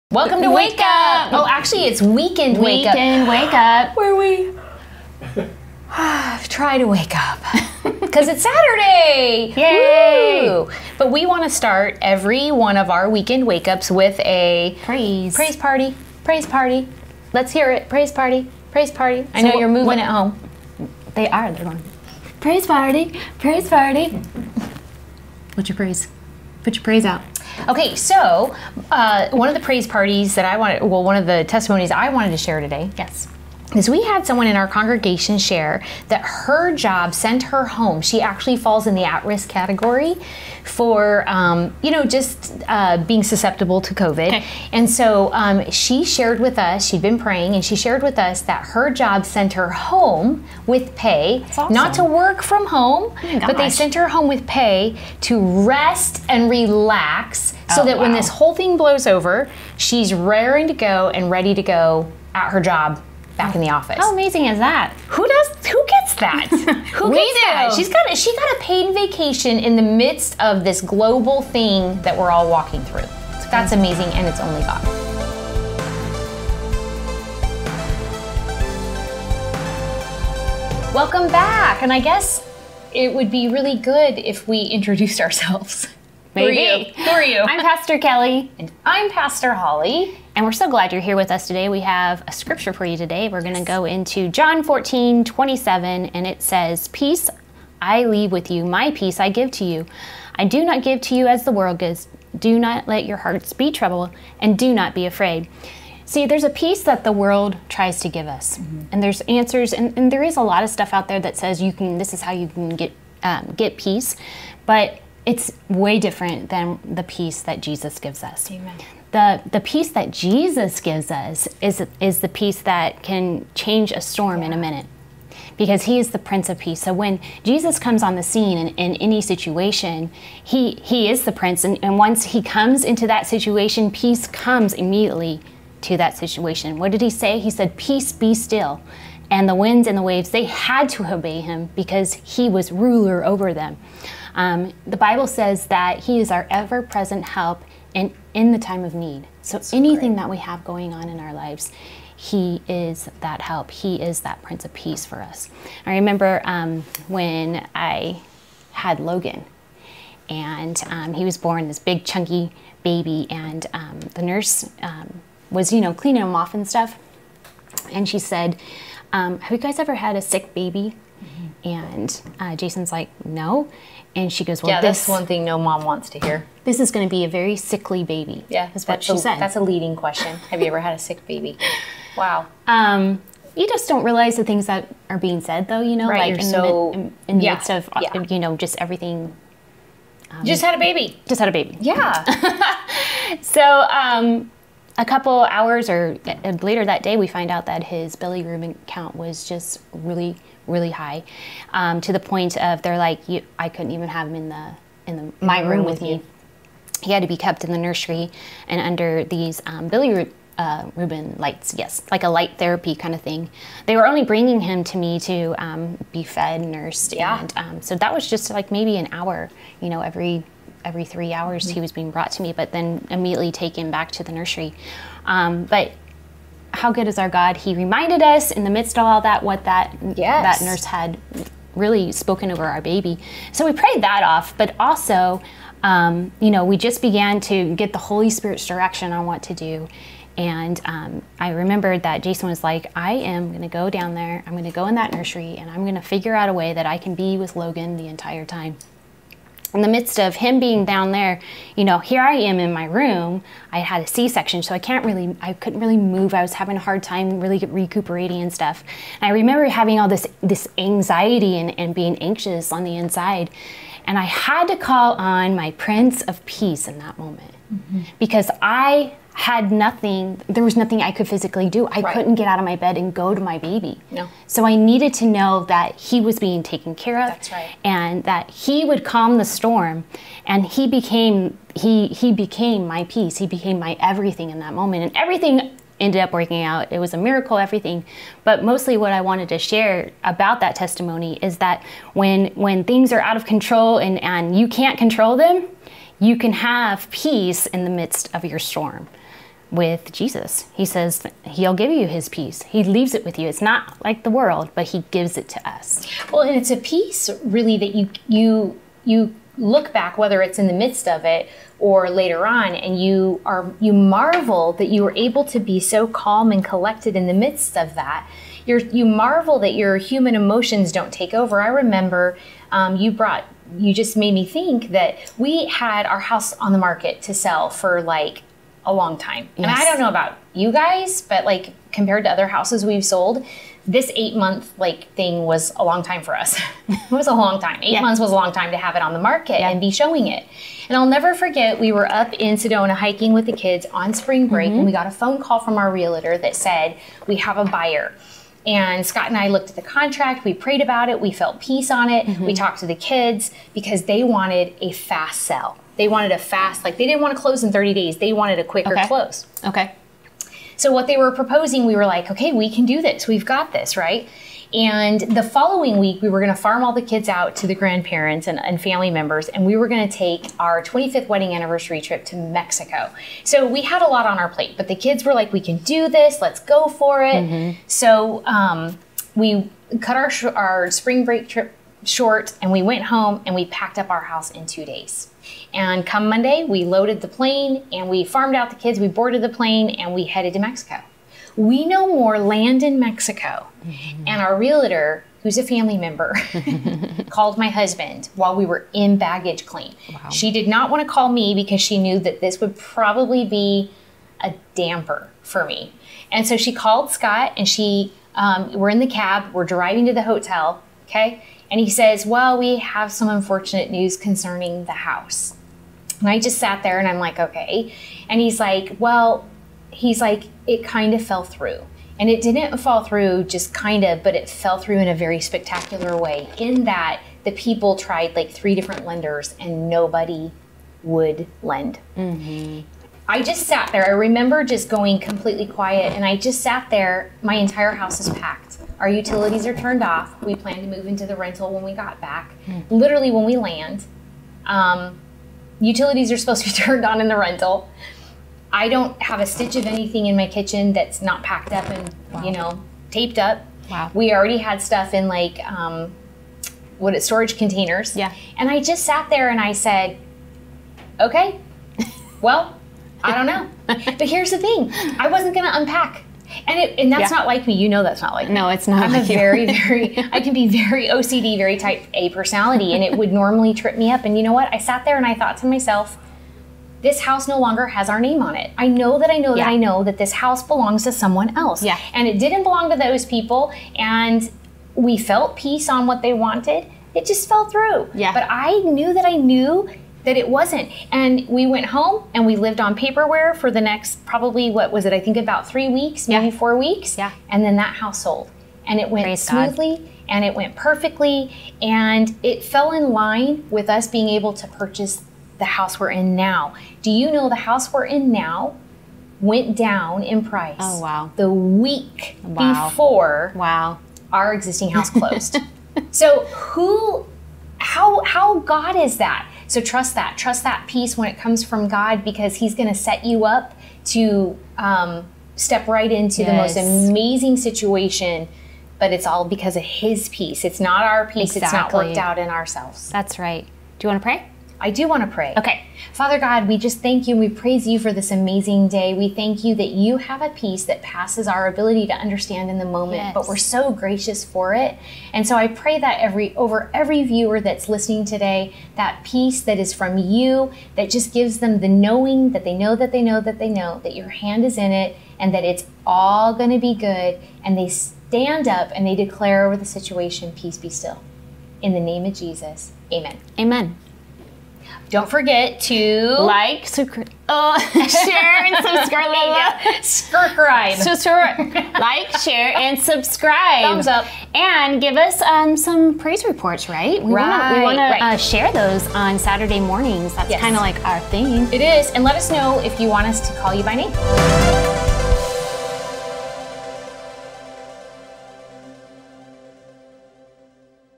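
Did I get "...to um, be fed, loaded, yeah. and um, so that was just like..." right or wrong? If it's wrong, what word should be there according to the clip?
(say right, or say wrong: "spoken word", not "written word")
wrong: "nursed", not "loaded".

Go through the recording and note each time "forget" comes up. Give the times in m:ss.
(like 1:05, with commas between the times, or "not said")
5:41, 9:25.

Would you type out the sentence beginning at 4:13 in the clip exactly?
I had a C-section, so I can't really, I couldn't really move.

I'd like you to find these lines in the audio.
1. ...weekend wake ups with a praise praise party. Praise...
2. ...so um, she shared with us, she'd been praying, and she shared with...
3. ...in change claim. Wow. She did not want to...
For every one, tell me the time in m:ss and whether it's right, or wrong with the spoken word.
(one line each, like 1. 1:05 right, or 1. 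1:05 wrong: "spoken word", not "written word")
1. 0:13 right
2. 0:44 right
3. 6:38 wrong: "baggage", not "change".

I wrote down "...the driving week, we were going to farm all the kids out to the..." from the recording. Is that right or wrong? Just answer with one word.
wrong.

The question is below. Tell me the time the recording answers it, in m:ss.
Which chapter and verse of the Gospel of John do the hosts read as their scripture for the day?
1:34.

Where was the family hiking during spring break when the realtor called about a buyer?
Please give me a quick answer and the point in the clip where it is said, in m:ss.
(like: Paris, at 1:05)
Sedona, at 5:42.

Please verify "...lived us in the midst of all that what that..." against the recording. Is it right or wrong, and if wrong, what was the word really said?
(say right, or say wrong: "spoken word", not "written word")
wrong: "reminded", not "lived".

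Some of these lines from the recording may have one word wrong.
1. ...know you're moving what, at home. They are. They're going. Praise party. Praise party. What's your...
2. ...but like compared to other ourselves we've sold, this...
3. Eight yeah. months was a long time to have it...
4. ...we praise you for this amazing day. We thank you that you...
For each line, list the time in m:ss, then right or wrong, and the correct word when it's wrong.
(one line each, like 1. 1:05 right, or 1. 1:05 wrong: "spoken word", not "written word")
1. 0:19 right
2. 5:31 wrong: "houses", not "ourselves"
3. 5:37 right
4. 8:57 right.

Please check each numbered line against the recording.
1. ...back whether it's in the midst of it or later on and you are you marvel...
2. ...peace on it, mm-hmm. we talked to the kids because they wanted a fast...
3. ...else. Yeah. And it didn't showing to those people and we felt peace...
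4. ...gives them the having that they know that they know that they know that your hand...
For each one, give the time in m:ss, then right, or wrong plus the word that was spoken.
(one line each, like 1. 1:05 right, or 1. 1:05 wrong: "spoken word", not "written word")
1. 5:09 right
2. 5:51 right
3. 8:01 wrong: "belong", not "showing"
4. 9:11 wrong: "knowing", not "having".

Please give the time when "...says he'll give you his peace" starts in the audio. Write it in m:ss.
5:00.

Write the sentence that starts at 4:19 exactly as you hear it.
And I remember having all this this anxiety and, and being anxious on the inside.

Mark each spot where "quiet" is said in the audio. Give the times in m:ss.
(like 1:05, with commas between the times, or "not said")
7:15.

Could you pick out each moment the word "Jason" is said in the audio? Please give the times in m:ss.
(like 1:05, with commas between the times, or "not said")
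2:52, 4:02.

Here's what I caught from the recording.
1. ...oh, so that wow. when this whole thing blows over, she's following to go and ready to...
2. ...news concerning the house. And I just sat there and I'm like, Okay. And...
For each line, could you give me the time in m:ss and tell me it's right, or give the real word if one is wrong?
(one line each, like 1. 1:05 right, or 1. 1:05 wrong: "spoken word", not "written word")
1. 0:57 wrong: "raring", not "following"
2. 6:53 right.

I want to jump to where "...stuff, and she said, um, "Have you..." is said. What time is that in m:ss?
2:46.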